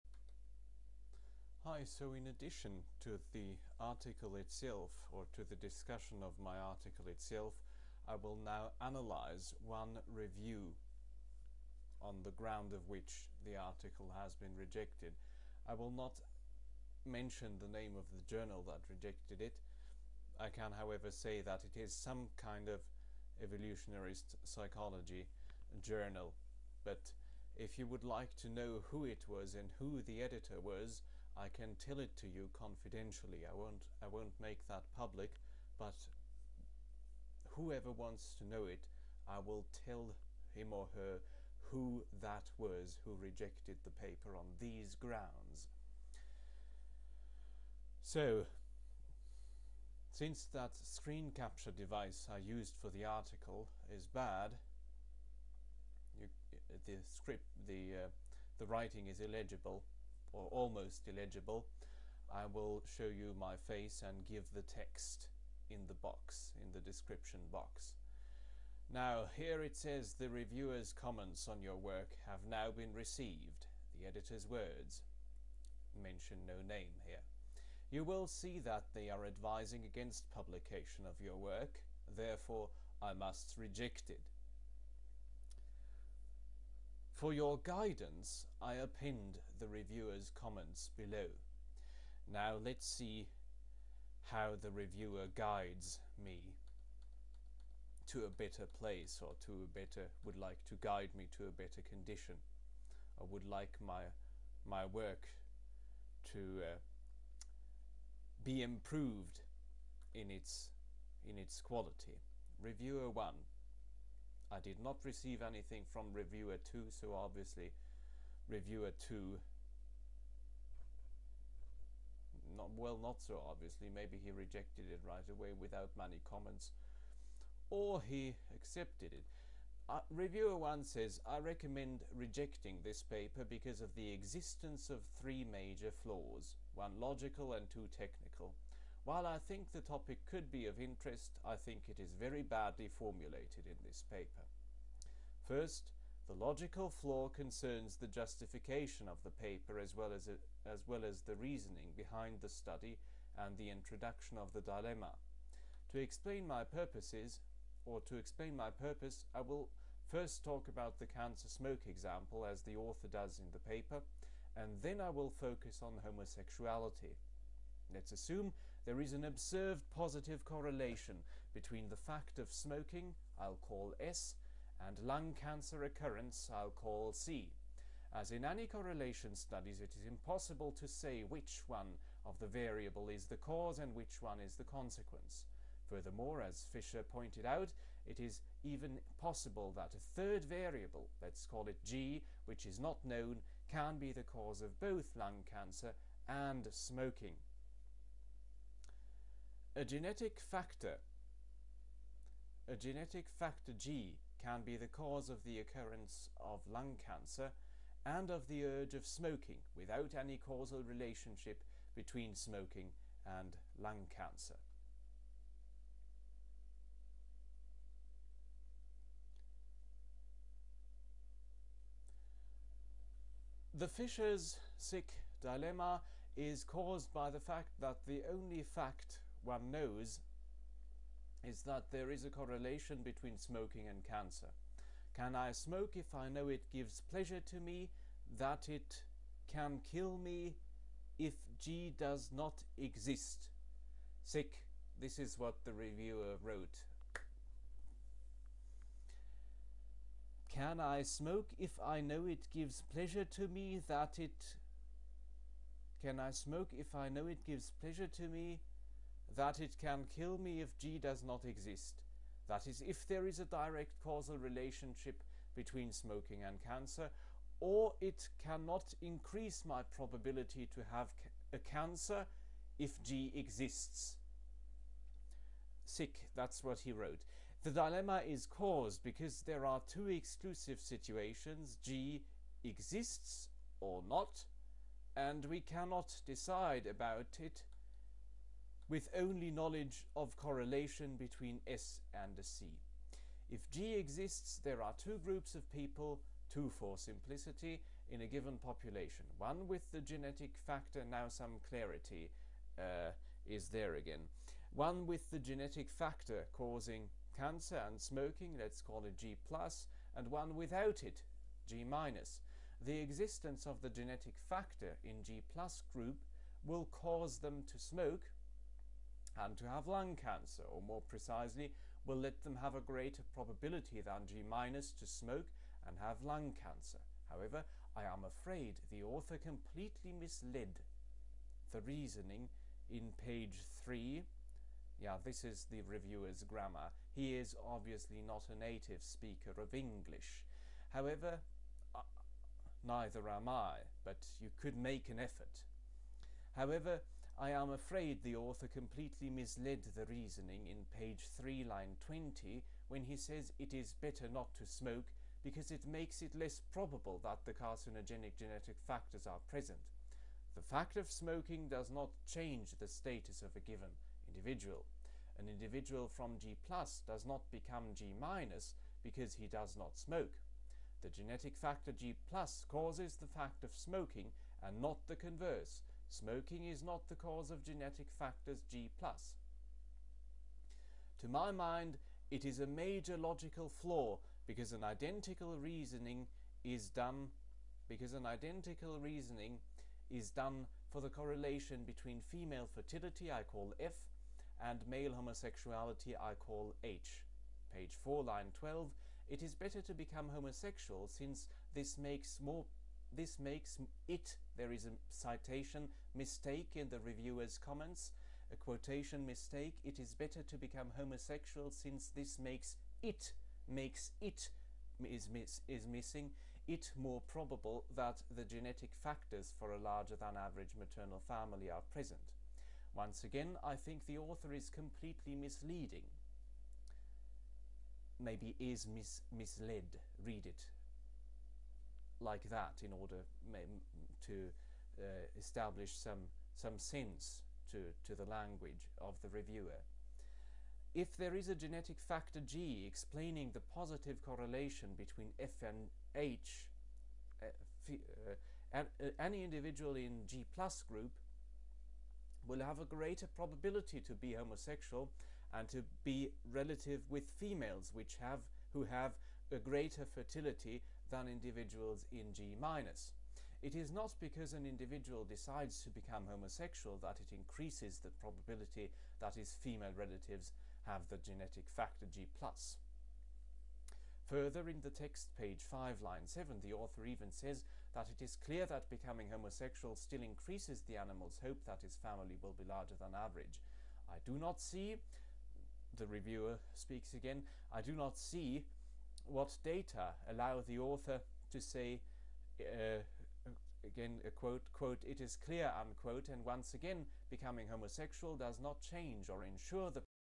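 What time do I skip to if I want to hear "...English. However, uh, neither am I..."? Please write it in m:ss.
5:39.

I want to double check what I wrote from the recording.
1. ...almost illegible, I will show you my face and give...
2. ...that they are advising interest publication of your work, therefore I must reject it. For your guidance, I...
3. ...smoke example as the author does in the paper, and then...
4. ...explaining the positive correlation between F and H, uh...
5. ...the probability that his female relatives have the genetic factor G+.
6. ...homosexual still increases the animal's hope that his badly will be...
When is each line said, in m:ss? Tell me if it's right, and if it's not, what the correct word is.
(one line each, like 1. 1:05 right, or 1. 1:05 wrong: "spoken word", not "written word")
1. 1:00 right
2. 1:18 wrong: "against", not "interest"
3. 2:41 right
4. 7:22 right
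5. 7:47 right
6. 7:59 wrong: "family", not "badly".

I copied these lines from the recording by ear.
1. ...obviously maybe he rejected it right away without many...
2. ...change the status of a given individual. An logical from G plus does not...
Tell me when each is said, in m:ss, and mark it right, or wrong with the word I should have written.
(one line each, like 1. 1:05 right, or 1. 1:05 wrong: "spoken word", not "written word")
1. 2:03 right
2. 6:02 wrong: "individual", not "logical".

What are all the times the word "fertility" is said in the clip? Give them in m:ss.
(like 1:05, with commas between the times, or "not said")
6:32, 7:40.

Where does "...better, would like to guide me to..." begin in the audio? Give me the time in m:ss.
1:39.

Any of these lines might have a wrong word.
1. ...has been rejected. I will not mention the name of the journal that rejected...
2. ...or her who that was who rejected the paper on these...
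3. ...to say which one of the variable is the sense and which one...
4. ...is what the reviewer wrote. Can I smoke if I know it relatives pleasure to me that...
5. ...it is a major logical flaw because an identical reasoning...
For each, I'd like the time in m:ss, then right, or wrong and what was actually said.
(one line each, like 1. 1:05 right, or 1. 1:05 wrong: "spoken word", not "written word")
1. 0:14 right
2. 0:40 right
3. 3:00 wrong: "cause", not "sense"
4. 4:05 wrong: "gives", not "relatives"
5. 6:22 right.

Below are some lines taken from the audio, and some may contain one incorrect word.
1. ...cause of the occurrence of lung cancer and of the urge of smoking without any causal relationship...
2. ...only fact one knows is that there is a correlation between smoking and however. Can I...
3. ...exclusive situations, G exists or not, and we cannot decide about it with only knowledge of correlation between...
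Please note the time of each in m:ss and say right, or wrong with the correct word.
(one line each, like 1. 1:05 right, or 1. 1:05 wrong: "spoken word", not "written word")
1. 3:24 right
2. 3:48 wrong: "cancer", not "however"
3. 4:40 right.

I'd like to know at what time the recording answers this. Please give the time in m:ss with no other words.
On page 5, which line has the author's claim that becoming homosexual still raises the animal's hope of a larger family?
7:56.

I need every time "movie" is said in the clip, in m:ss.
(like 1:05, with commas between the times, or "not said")
not said.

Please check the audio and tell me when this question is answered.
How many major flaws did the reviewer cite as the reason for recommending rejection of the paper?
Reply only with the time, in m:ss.
2:15.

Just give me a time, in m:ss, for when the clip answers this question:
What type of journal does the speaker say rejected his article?
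0:23.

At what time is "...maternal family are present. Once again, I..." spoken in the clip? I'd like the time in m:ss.
7:00.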